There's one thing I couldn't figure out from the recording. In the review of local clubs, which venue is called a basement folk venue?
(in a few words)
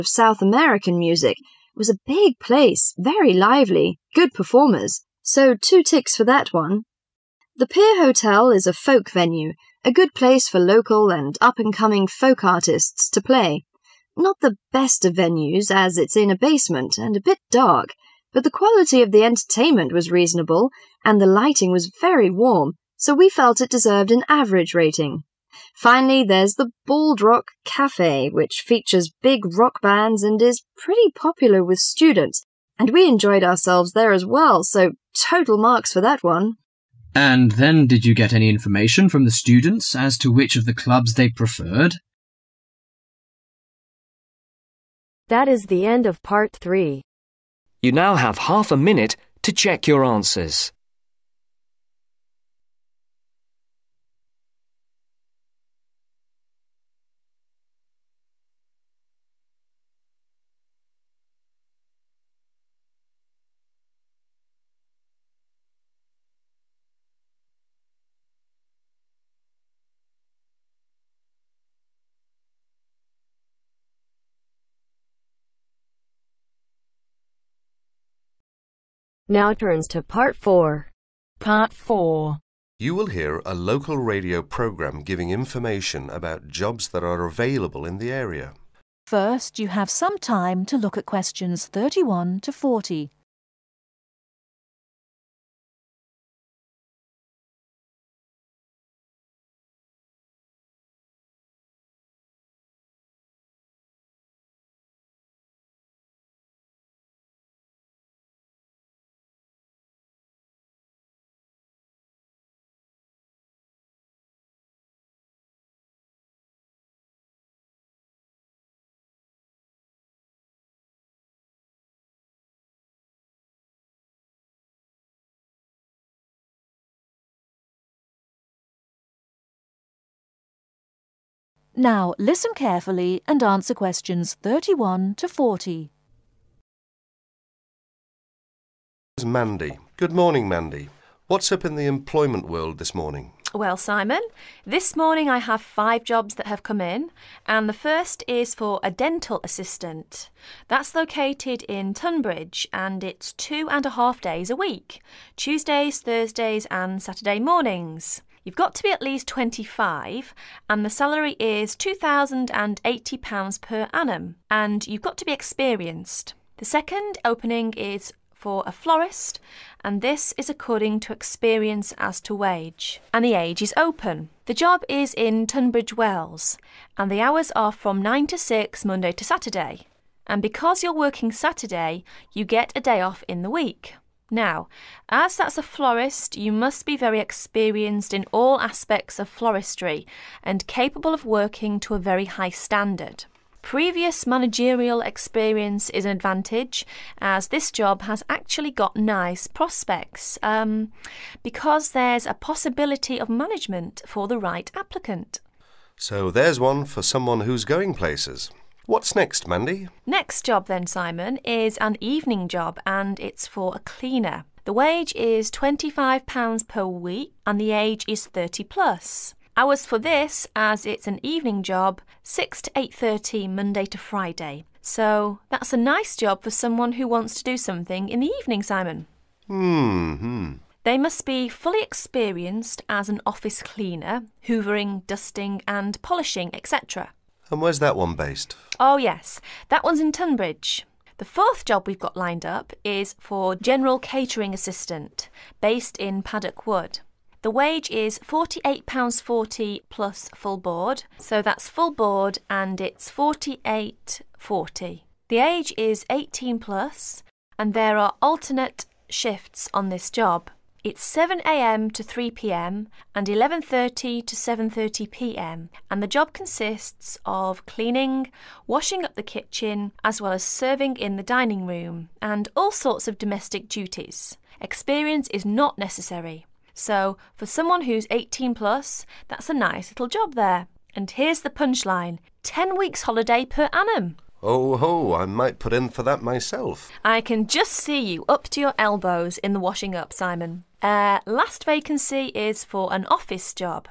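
The Pier Hotel.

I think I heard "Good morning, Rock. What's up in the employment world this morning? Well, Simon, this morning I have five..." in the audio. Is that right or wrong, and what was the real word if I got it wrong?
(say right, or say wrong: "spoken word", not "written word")
wrong: "Mandy", not "Rock".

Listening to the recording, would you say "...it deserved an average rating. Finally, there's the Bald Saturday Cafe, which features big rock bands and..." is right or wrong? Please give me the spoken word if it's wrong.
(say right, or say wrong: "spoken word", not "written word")
wrong: "Rock", not "Saturday".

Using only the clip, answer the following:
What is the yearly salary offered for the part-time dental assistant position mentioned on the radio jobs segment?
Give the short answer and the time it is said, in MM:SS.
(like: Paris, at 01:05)
£2,080, at 02:41.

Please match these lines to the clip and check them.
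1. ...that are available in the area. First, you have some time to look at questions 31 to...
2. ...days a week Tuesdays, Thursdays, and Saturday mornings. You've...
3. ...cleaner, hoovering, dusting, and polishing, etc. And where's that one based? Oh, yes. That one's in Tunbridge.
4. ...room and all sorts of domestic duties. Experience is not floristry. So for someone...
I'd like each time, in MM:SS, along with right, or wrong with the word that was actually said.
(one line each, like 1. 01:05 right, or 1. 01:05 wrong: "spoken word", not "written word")
1. 01:26 right
2. 02:34 right
3. 03:53 right
4. 04:31 wrong: "necessary", not "floristry".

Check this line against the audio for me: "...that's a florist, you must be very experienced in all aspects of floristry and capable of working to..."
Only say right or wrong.
right.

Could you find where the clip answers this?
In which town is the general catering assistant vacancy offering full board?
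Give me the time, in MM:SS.
04:06.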